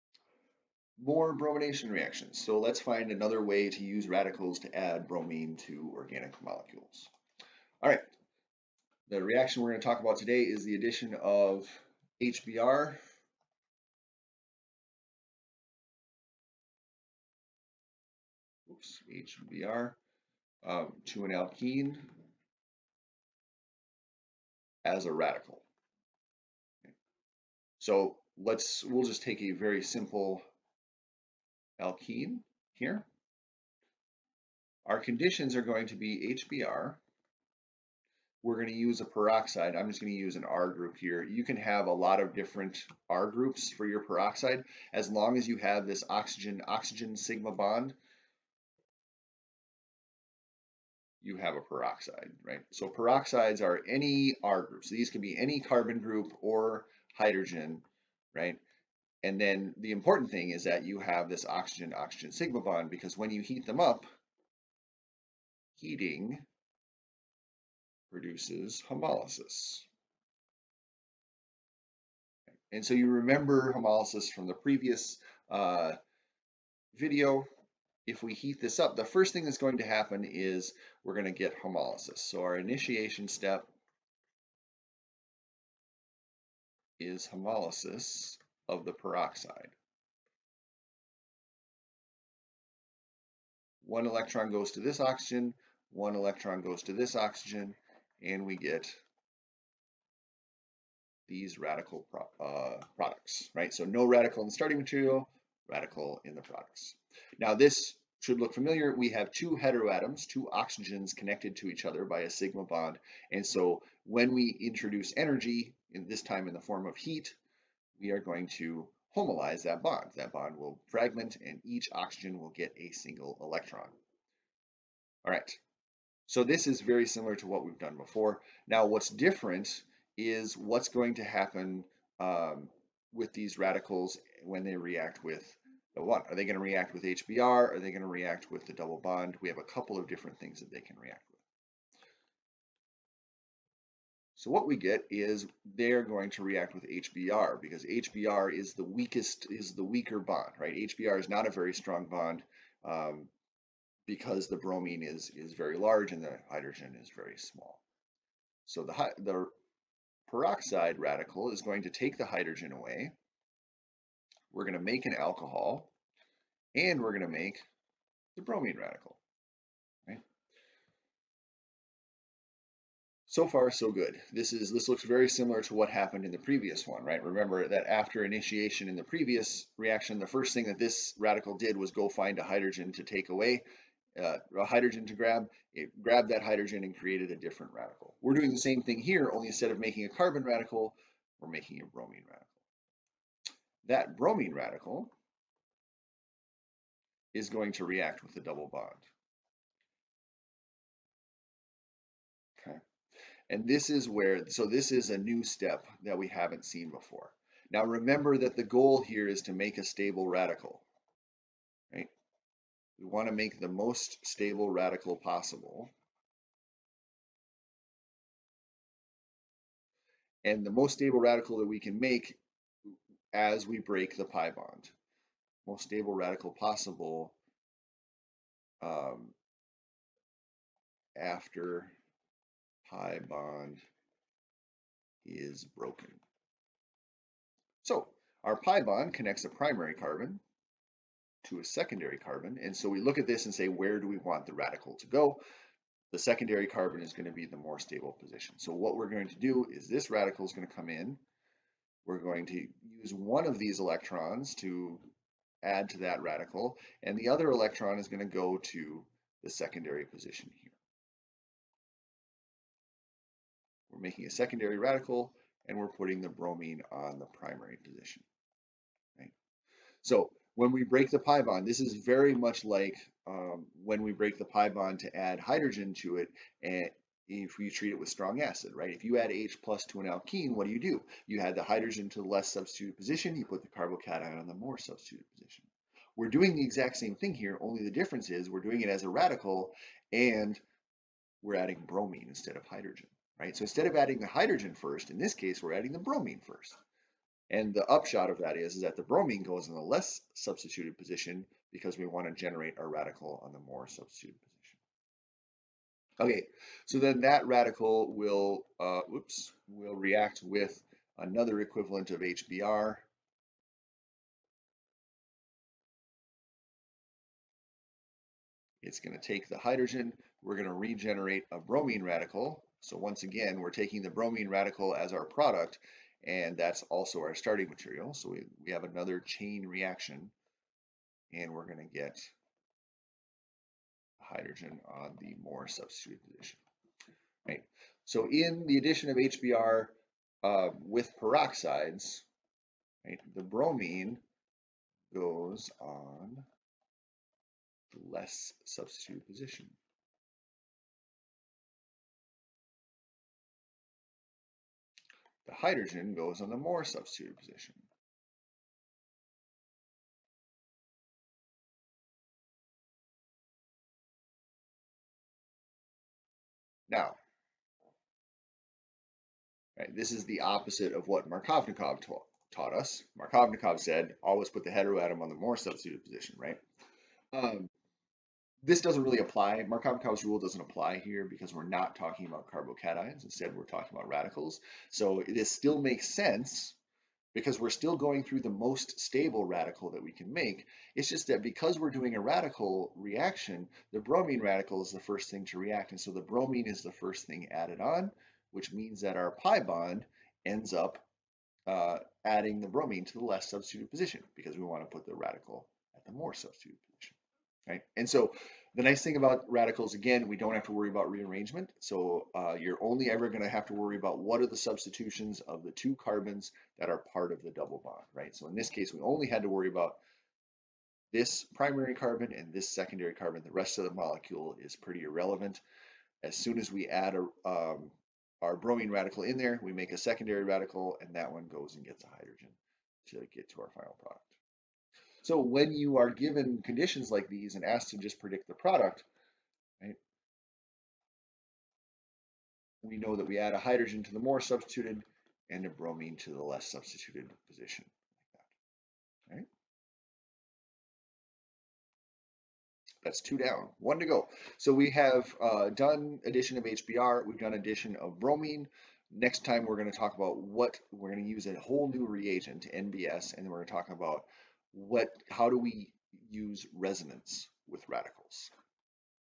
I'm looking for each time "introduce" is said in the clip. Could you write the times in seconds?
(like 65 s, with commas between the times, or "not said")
114 s.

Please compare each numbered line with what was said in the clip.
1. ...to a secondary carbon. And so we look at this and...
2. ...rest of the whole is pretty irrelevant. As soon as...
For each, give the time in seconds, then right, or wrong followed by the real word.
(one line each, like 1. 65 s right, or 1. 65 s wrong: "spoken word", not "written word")
1. 241 s right
2. 423 s wrong: "molecule", not "whole".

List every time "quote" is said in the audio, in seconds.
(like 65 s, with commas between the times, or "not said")
not said.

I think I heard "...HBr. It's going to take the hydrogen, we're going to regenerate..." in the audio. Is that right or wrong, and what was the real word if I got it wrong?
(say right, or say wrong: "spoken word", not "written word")
right.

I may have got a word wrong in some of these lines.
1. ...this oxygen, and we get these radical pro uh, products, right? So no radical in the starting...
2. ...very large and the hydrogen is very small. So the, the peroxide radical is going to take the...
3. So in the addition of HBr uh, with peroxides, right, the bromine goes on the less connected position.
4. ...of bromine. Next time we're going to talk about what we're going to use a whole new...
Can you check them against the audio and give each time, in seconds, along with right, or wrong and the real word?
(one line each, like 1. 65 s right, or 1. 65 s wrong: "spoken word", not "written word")
1. 96 s right
2. 155 s right
3. 338 s wrong: "substituted", not "connected"
4. 457 s right.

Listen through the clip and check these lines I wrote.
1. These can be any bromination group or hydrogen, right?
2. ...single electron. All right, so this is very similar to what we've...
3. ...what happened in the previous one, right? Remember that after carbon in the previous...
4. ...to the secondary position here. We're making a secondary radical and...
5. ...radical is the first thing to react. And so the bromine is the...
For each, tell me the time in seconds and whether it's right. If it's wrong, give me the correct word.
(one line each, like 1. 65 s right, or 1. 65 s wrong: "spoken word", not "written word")
1. 54 s wrong: "carbon", not "bromination"
2. 122 s right
3. 175 s wrong: "initiation", not "carbon"
4. 258 s right
5. 394 s right.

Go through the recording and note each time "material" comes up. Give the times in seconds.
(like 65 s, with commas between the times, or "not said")
104 s, 327 s.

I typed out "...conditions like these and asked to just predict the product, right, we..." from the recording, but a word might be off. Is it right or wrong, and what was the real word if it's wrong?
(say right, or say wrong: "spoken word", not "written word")
right.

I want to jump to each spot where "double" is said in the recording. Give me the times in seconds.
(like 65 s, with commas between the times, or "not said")
138 s, 198 s, 417 s.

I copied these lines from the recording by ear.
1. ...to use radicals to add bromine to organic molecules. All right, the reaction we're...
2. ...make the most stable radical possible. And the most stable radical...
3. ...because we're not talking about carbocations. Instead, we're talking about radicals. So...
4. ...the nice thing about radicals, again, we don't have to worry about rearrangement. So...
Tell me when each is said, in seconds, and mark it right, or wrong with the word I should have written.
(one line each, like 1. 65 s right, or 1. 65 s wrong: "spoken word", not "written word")
1. 3 s right
2. 213 s right
3. 381 s right
4. 408 s right.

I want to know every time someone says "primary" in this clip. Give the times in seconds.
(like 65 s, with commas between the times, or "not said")
239 s, 267 s, 421 s.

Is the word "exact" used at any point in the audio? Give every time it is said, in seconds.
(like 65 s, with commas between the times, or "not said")
286 s.